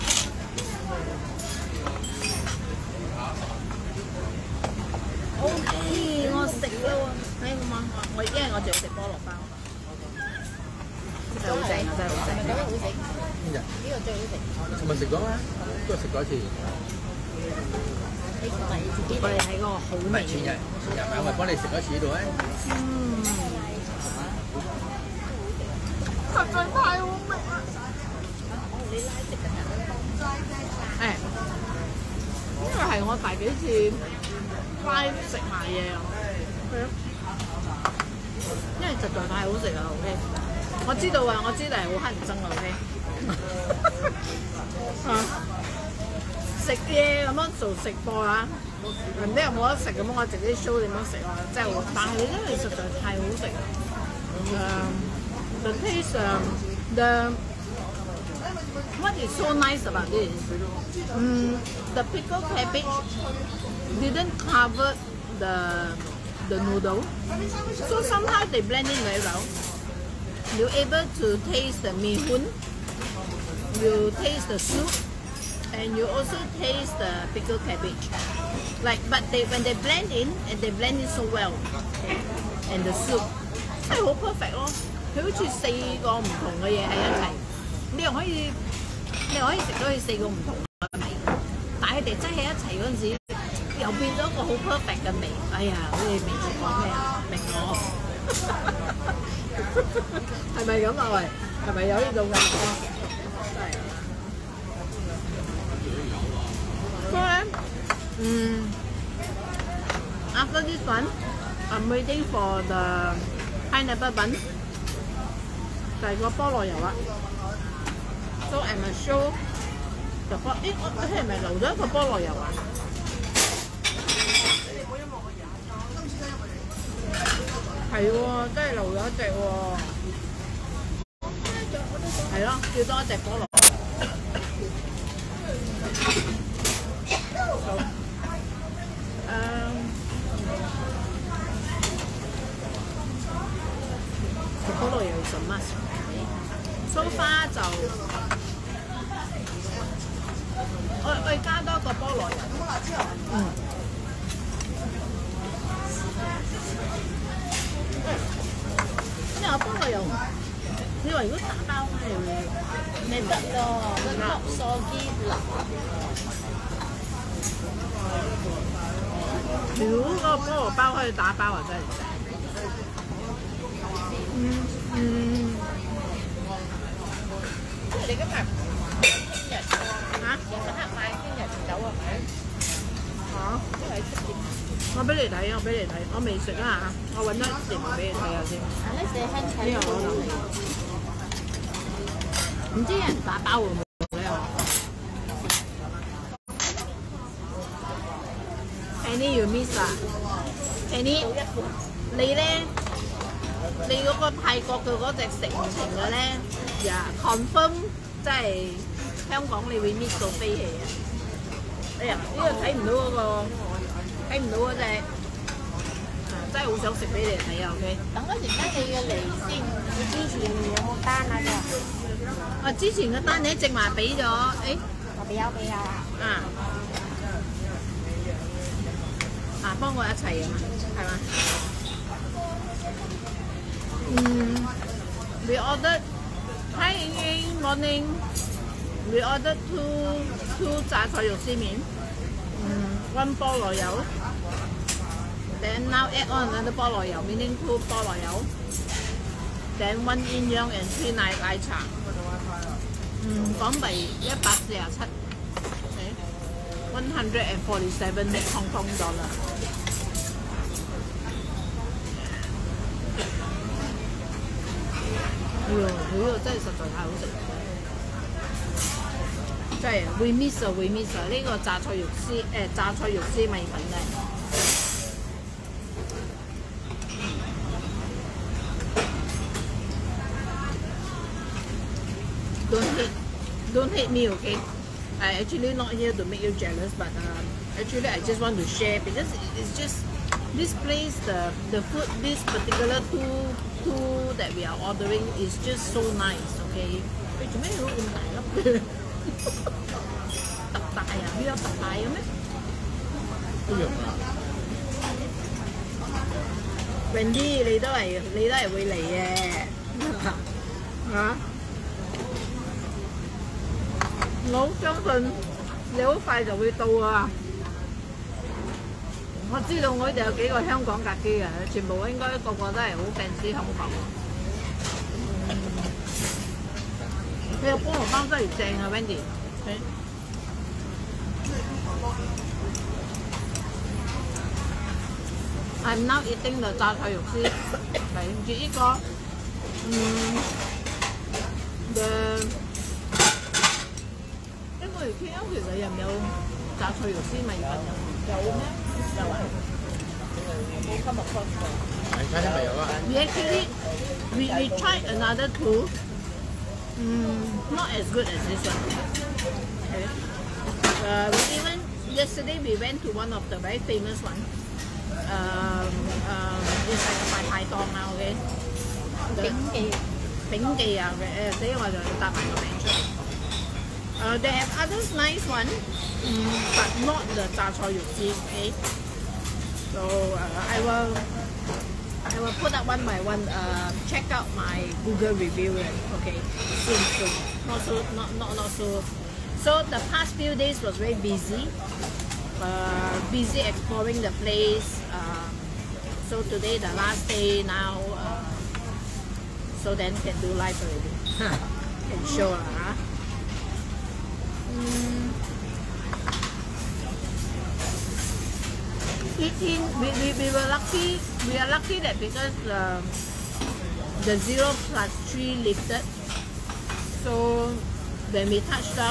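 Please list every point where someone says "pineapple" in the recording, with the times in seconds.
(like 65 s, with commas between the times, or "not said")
113 s.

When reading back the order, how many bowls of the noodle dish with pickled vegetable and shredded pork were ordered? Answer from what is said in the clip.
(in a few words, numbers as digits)
2.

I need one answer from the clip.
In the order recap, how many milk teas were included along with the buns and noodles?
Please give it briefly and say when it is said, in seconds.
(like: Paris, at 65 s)
2, at 250 s.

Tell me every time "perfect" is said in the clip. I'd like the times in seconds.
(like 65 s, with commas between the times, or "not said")
84 s, 94 s.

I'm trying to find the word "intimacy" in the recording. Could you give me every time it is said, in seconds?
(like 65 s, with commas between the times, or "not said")
not said.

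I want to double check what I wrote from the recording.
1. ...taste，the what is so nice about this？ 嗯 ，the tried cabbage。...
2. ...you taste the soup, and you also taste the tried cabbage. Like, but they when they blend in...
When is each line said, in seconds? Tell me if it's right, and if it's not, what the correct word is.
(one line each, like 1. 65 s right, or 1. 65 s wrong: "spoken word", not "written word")
1. 55 s wrong: "pickled", not "tried"
2. 73 s wrong: "pickled", not "tried".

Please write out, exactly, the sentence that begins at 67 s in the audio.
So somehow they blend in very well.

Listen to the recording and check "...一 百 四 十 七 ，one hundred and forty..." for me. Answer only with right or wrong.
right.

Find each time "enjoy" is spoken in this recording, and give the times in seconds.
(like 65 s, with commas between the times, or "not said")
not said.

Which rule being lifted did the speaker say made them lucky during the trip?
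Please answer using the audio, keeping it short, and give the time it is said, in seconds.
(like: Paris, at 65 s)
0 plus 3, at 414 s.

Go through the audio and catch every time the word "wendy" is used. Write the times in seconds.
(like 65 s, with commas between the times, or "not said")
307 s, 328 s.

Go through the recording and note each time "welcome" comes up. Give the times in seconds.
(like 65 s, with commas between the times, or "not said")
not said.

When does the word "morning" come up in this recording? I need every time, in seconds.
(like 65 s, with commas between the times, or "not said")
237 s.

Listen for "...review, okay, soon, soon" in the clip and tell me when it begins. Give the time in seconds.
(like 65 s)
385 s.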